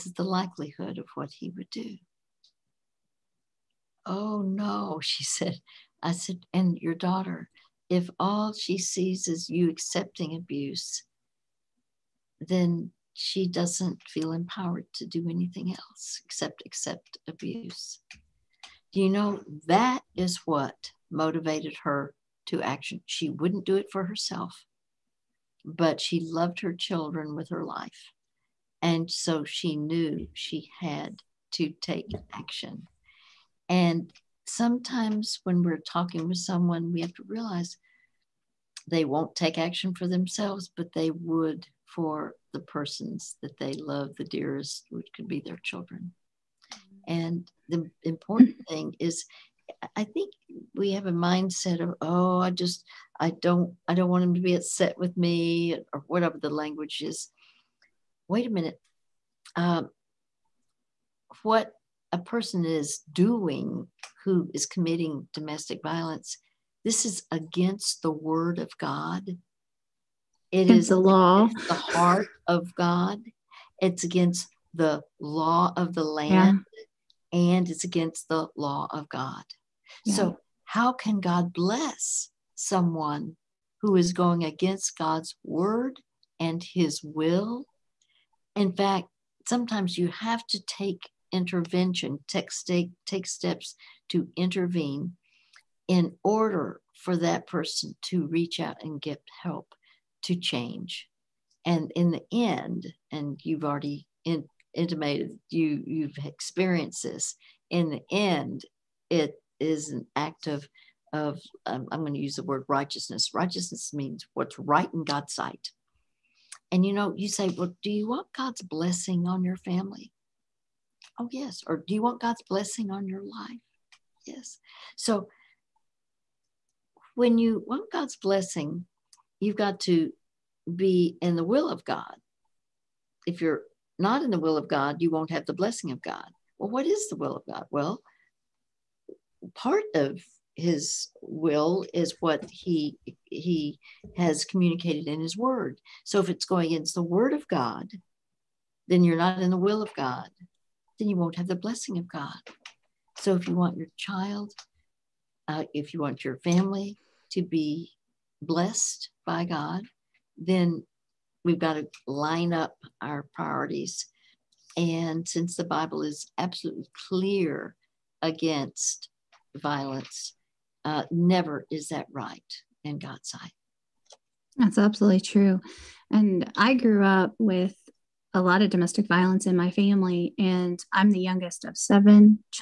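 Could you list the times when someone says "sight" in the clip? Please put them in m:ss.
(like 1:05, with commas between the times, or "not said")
1:55, 2:53.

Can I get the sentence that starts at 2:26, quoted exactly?
So if it's going against the word of God, then you're not in the will of God.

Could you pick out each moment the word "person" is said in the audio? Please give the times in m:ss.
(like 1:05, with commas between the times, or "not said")
0:42, 1:02, 1:37.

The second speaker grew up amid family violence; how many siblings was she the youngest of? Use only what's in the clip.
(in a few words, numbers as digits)
7.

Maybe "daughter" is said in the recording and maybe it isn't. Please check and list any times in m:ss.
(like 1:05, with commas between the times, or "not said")
0:06.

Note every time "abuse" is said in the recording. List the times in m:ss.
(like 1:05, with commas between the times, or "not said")
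0:10, 0:17.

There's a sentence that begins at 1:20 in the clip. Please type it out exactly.
So, how can God bless someone who is going against God's word and his will?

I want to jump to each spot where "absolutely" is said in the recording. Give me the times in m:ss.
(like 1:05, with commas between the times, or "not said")
2:46, 2:54.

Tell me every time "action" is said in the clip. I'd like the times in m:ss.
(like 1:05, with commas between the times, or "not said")
0:22, 0:32, 0:39.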